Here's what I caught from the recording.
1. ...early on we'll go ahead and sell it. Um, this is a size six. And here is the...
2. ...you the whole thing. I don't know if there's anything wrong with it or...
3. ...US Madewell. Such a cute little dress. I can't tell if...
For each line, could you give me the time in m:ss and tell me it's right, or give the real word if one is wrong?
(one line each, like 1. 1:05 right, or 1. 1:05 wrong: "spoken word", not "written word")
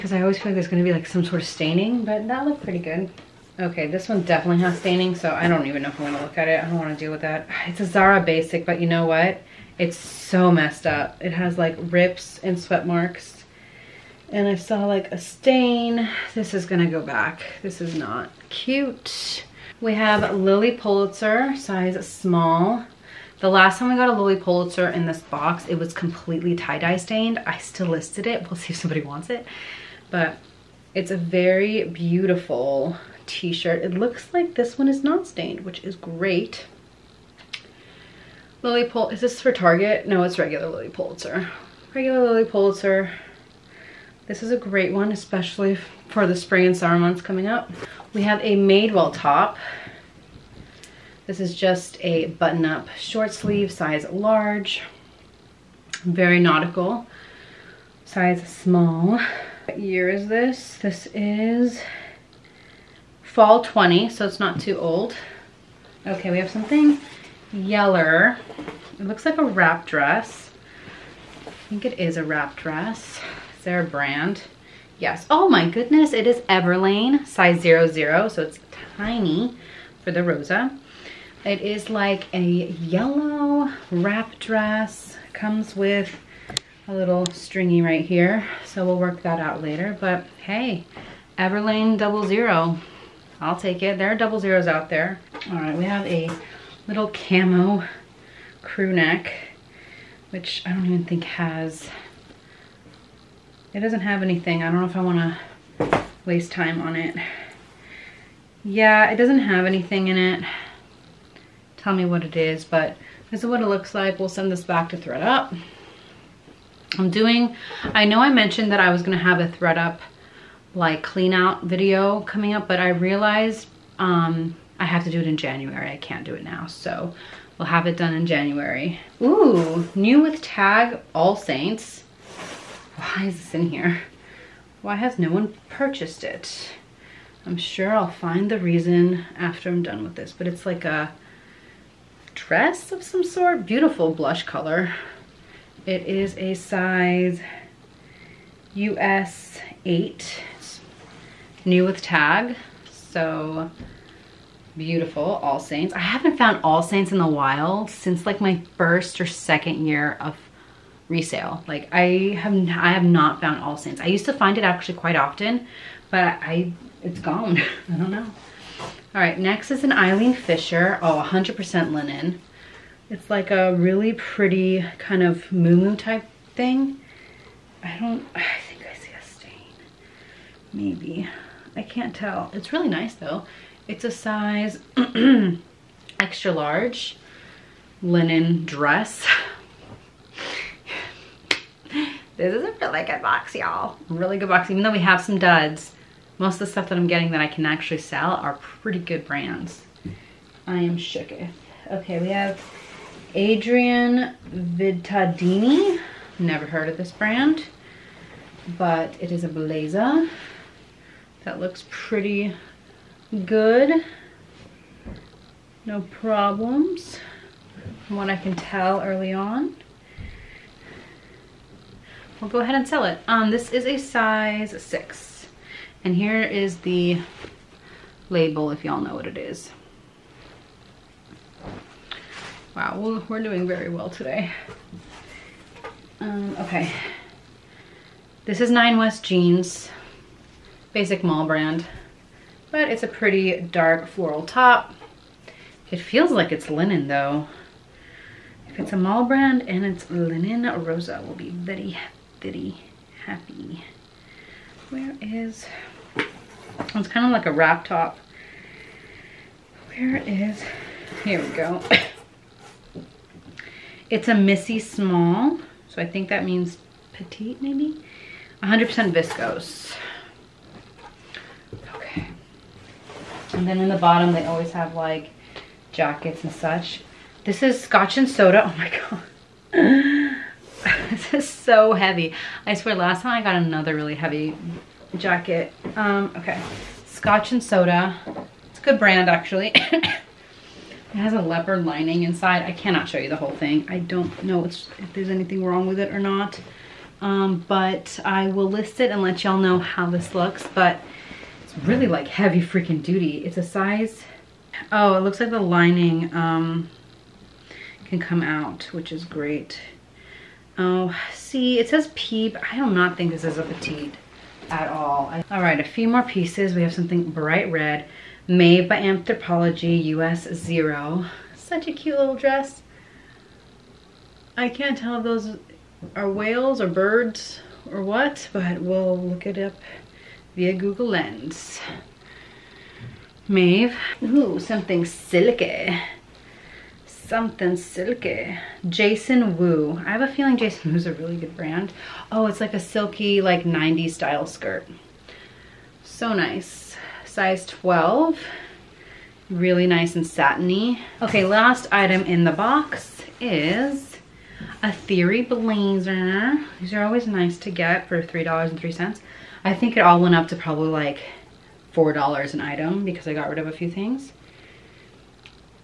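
1. 3:39 right
2. 4:53 right
3. 5:20 wrong: "Zero", not "Madewell".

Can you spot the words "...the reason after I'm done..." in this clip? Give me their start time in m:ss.
2:18.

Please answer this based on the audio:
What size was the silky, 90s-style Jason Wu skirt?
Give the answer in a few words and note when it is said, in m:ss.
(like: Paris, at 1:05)
12, at 5:47.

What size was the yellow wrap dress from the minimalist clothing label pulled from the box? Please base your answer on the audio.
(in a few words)
00.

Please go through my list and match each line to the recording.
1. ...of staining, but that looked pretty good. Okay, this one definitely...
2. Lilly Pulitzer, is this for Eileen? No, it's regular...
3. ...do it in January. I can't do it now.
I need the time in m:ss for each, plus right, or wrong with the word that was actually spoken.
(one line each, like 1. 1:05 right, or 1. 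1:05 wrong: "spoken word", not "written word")
1. 0:01 right
2. 0:38 wrong: "Target", not "Eileen"
3. 2:05 right.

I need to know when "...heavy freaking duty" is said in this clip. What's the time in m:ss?
5:02.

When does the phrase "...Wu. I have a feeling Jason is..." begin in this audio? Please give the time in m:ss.
5:39.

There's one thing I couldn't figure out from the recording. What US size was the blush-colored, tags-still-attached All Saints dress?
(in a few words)
US 8.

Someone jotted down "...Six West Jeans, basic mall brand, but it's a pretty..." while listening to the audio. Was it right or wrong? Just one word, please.
wrong.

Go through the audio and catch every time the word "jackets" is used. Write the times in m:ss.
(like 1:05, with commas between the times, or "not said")
4:35, 4:45.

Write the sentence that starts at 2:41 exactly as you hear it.
Like I have, I have not found All Saints.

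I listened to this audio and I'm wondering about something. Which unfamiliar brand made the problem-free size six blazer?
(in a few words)
Adrienne Vittadini.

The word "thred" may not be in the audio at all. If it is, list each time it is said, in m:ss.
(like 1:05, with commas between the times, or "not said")
1:54, 1:59.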